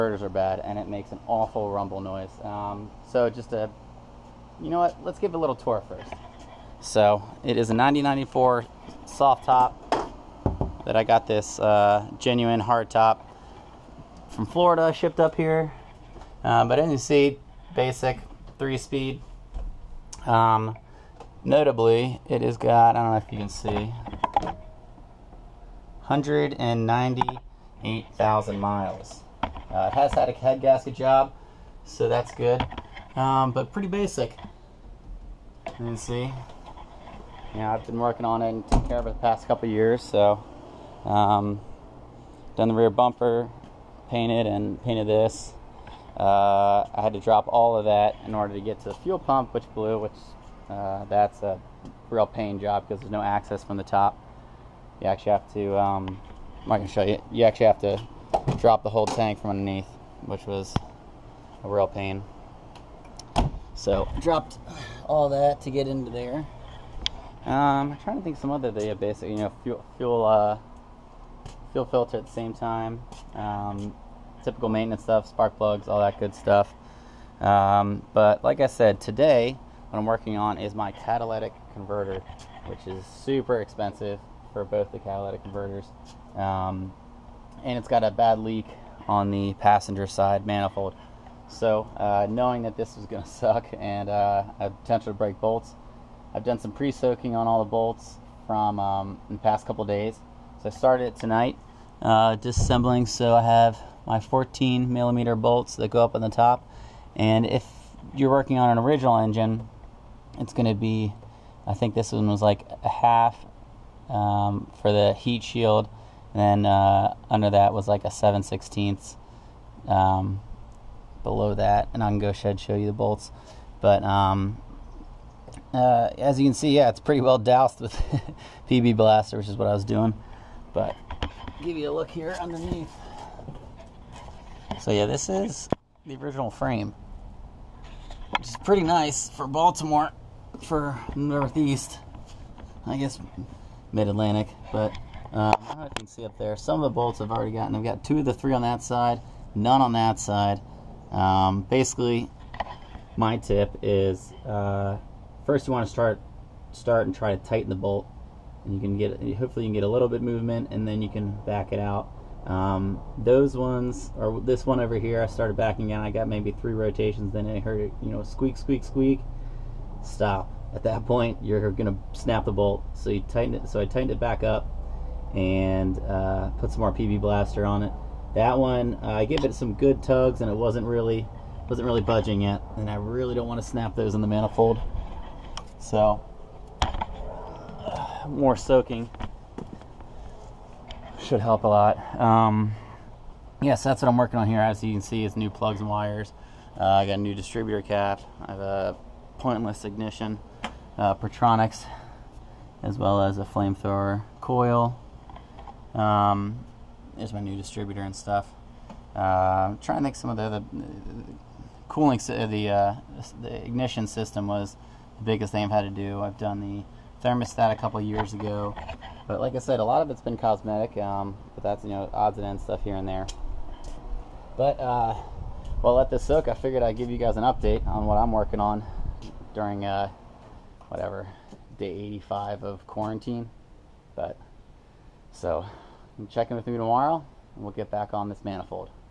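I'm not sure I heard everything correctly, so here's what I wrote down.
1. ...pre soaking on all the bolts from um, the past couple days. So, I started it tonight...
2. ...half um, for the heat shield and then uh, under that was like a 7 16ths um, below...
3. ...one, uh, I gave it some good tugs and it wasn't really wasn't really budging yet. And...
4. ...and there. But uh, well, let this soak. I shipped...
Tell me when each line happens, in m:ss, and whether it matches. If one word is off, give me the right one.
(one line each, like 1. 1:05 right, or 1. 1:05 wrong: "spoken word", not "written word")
1. 1:36 right
2. 1:52 right
3. 2:58 right
4. 3:42 wrong: "figured", not "shipped".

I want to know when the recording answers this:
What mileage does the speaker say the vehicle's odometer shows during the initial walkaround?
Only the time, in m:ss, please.
0:26.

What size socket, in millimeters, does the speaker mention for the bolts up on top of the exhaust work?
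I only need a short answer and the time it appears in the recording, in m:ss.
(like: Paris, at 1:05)
14 millimeter, at 1:44.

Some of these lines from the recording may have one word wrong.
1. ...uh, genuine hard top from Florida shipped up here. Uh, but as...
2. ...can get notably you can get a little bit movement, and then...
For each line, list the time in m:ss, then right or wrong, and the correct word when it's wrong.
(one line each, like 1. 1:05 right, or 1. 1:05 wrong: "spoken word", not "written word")
1. 0:11 right
2. 2:38 wrong: "hopefully", not "notably".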